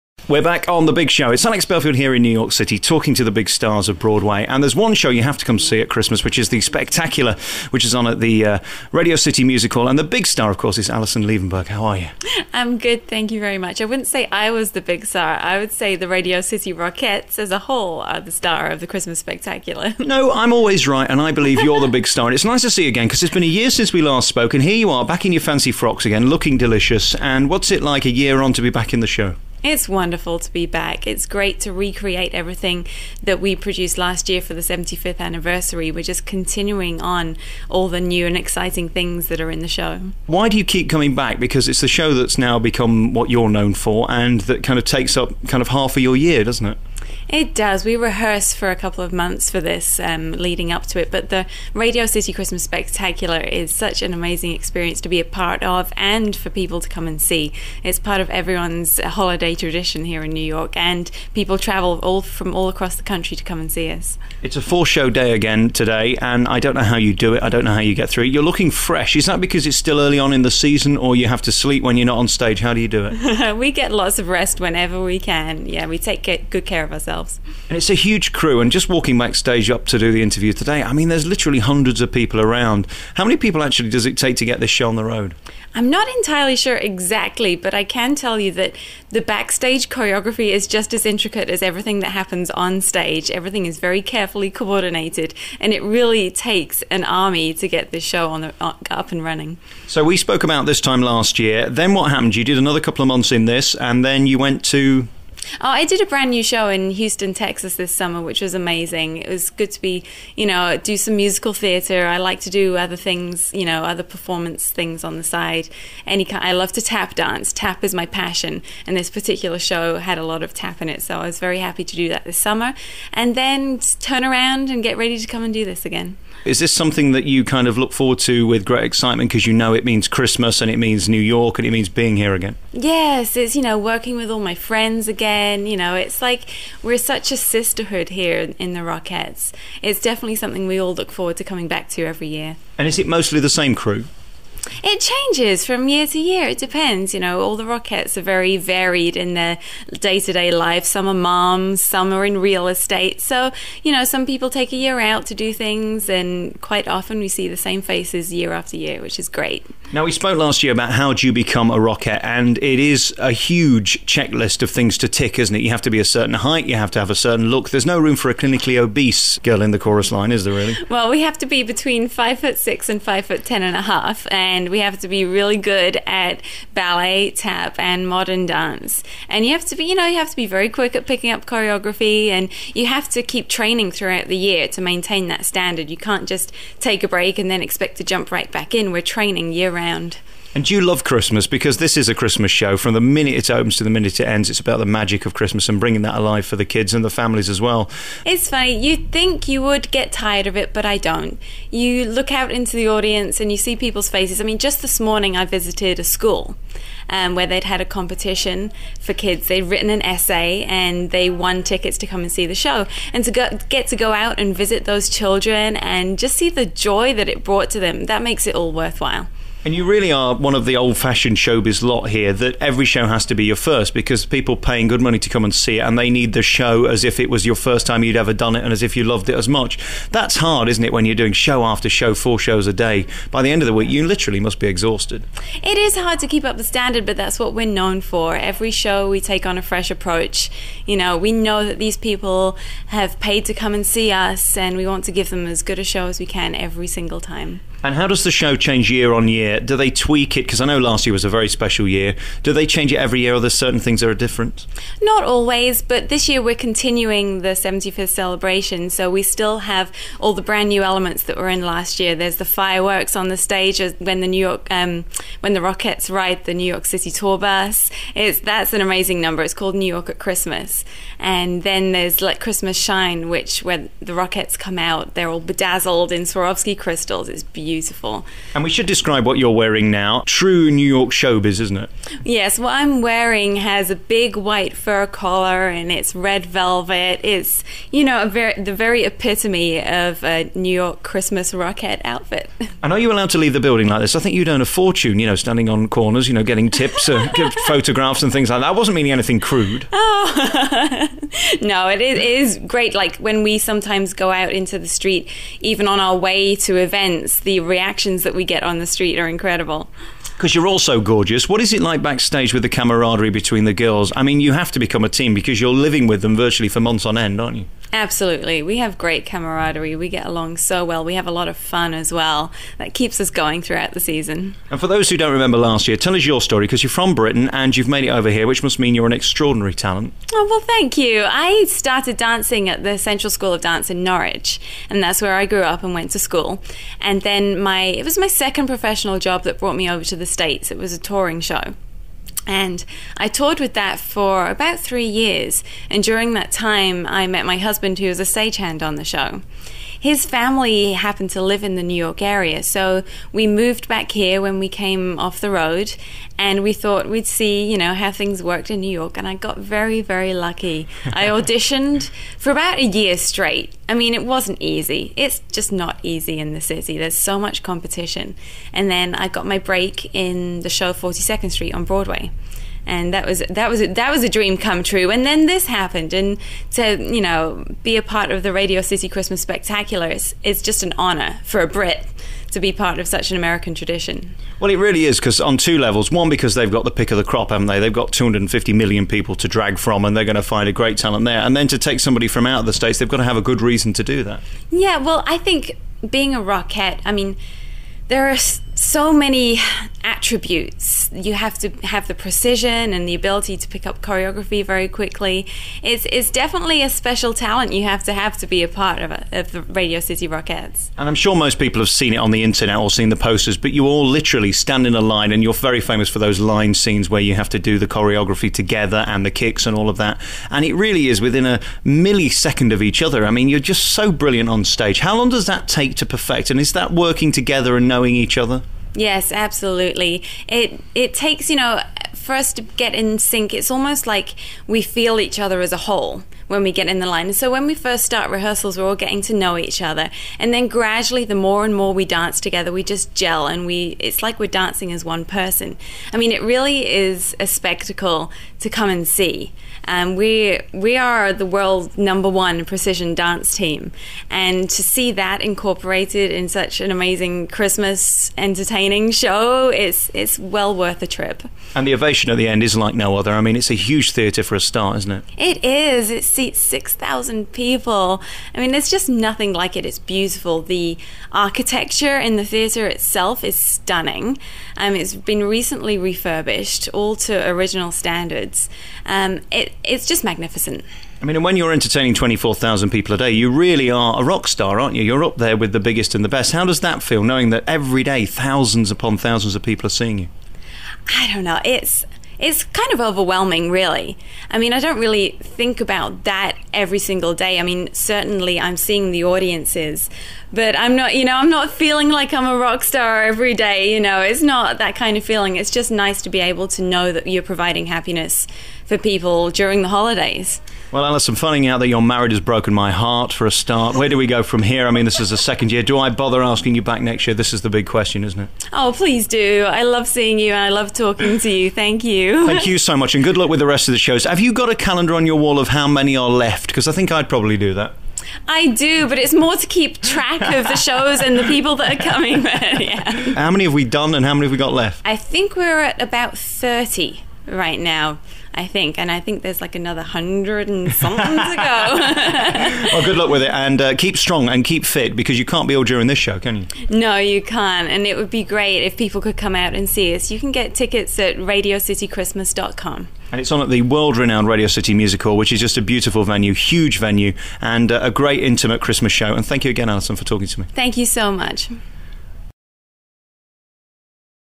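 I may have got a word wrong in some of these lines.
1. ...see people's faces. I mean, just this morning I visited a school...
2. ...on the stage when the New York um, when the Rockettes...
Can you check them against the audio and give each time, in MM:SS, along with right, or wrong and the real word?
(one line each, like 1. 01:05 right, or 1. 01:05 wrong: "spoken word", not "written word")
1. 03:23 right
2. 04:23 right.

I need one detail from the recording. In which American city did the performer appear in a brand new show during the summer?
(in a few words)
Houston, Texas.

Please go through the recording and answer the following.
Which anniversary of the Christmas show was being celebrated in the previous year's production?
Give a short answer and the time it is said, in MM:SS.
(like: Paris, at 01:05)
75th, at 00:34.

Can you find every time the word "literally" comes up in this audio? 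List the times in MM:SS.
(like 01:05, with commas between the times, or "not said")
01:21, 03:54, 06:54.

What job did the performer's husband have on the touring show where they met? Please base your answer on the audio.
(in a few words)
Stagehand.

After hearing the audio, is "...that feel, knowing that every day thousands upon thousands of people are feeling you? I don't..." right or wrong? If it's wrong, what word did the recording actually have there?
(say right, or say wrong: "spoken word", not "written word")
wrong: "seeing", not "feeling".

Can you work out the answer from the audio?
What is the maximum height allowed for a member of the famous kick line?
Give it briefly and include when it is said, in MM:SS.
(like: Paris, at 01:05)
5 foot 10 and a half, at 02:53.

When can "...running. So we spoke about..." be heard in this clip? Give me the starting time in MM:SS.
01:39.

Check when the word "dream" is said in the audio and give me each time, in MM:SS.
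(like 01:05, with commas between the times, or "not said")
06:14.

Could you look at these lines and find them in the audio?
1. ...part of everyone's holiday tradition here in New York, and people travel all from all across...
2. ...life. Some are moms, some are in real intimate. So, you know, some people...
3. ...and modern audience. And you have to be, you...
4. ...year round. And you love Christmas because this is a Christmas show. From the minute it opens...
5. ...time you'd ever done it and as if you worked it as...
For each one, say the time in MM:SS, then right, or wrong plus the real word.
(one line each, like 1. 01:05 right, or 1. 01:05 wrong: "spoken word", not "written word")
1. 00:57 right
2. 02:30 wrong: "estate", not "intimate"
3. 02:57 wrong: "dance", not "audience"
4. 03:09 right
5. 03:47 wrong: "loved", not "worked".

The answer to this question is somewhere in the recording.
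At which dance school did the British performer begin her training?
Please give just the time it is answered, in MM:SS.
05:32.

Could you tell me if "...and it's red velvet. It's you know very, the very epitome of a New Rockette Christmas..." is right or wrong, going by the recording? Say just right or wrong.
wrong.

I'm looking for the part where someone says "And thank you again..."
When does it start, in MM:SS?
09:19.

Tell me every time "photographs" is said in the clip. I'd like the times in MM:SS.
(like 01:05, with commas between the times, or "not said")
04:57.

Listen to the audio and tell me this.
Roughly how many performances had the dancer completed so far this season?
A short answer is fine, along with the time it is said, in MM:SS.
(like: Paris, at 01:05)
30, at 08:56.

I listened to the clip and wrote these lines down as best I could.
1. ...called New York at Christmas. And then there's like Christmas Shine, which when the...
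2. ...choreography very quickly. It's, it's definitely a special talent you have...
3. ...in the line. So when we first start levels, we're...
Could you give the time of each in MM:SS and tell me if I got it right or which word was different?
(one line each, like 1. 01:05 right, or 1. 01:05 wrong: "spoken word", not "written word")
1. 04:29 right
2. 06:44 right
3. 07:16 wrong: "rehearsals", not "levels".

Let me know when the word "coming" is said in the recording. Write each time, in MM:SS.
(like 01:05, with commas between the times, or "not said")
00:40, 02:21, 08:52.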